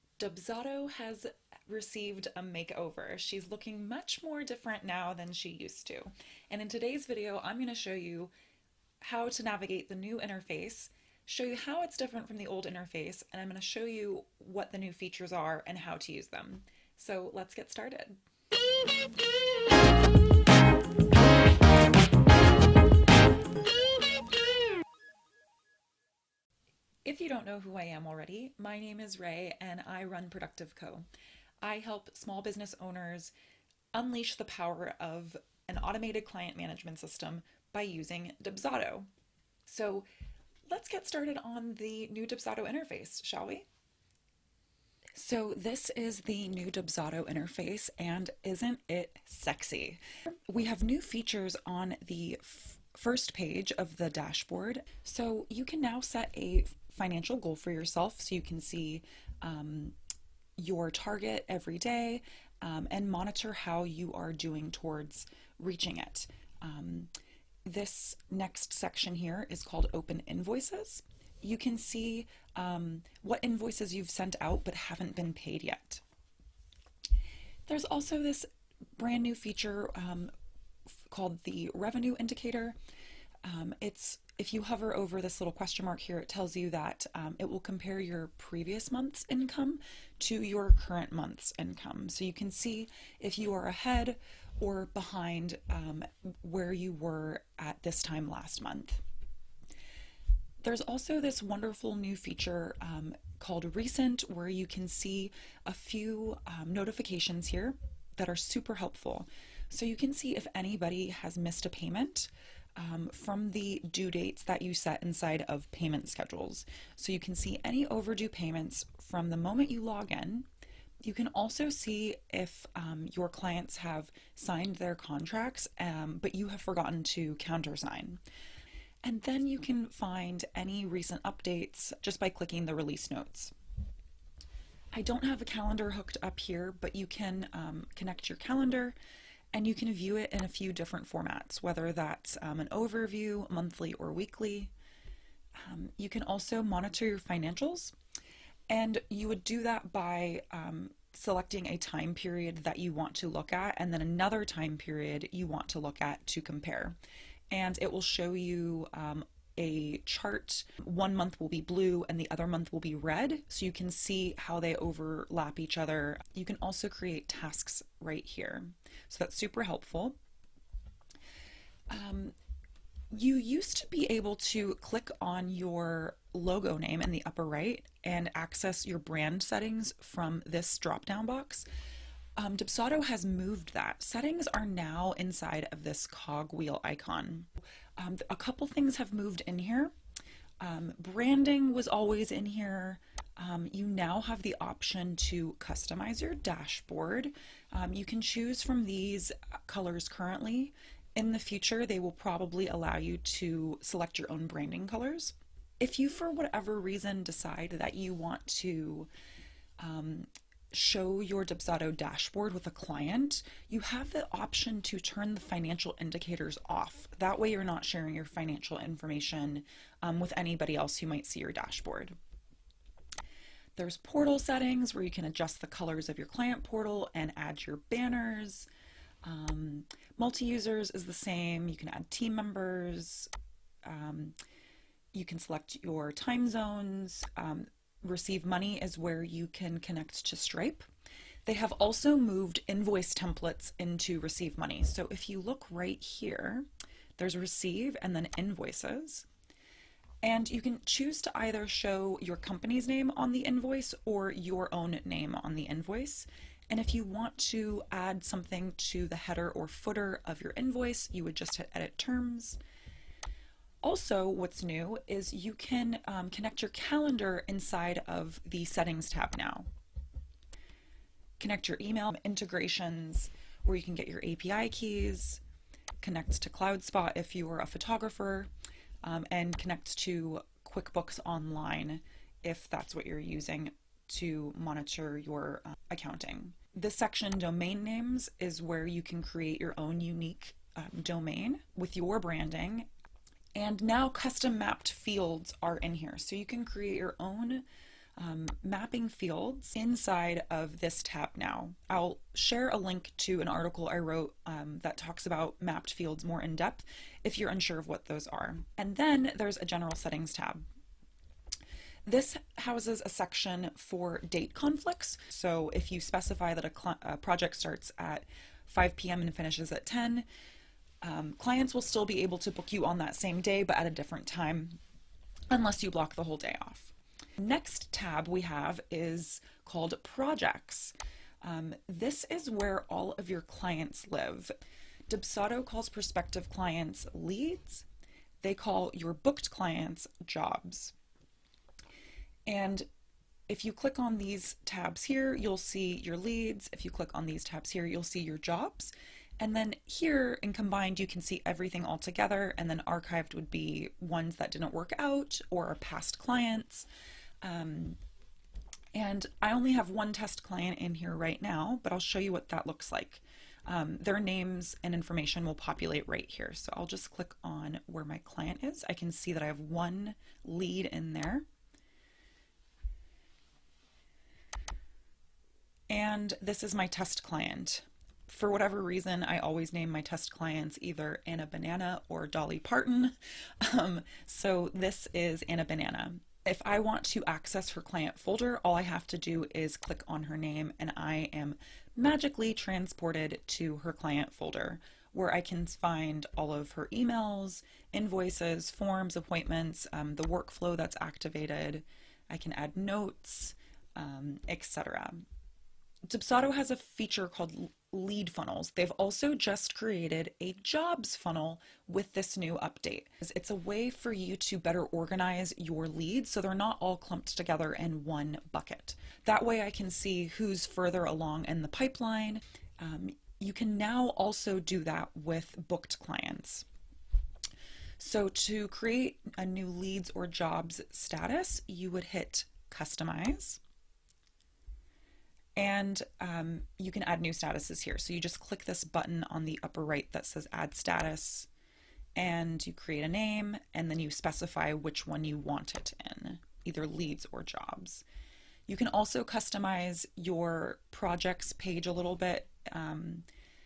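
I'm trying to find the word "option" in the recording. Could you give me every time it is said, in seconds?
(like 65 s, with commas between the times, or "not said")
194 s, 214 s.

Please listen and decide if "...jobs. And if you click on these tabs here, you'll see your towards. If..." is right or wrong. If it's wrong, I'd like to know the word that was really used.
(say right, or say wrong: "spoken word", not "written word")
wrong: "leads", not "towards".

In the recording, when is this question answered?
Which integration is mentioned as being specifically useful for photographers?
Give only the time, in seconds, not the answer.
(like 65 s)
276 s.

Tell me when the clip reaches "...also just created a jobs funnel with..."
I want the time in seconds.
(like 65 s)
408 s.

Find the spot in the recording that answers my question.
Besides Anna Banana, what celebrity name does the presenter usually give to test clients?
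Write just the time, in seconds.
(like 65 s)
382 s.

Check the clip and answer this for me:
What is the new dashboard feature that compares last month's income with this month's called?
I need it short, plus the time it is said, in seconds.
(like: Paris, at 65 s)
revenue indicator, at 81 s.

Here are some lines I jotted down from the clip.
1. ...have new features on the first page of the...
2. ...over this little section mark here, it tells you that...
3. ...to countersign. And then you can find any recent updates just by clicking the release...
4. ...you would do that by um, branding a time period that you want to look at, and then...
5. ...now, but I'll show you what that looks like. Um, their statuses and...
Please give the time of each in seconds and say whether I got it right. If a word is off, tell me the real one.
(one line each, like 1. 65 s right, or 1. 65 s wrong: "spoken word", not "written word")
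1. 50 s right
2. 84 s wrong: "question", not "section"
3. 127 s right
4. 149 s wrong: "selecting", not "branding"
5. 361 s wrong: "names", not "statuses".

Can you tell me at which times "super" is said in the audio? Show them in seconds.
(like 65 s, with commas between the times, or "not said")
108 s, 169 s.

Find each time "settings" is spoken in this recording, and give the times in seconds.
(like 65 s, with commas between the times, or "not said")
179 s, 184 s, 224 s, 268 s, 309 s.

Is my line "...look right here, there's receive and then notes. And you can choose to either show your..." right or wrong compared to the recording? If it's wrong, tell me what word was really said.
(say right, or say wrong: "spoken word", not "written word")
wrong: "invoices", not "notes".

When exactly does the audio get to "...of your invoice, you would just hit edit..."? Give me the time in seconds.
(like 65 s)
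260 s.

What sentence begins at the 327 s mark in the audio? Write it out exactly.
Next tab we have is called Projects.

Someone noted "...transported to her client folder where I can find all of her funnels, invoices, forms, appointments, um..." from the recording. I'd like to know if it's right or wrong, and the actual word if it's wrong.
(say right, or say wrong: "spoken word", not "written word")
wrong: "emails", not "funnels".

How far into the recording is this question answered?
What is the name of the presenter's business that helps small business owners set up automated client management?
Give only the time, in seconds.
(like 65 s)
30 s.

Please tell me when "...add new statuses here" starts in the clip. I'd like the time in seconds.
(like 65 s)
437 s.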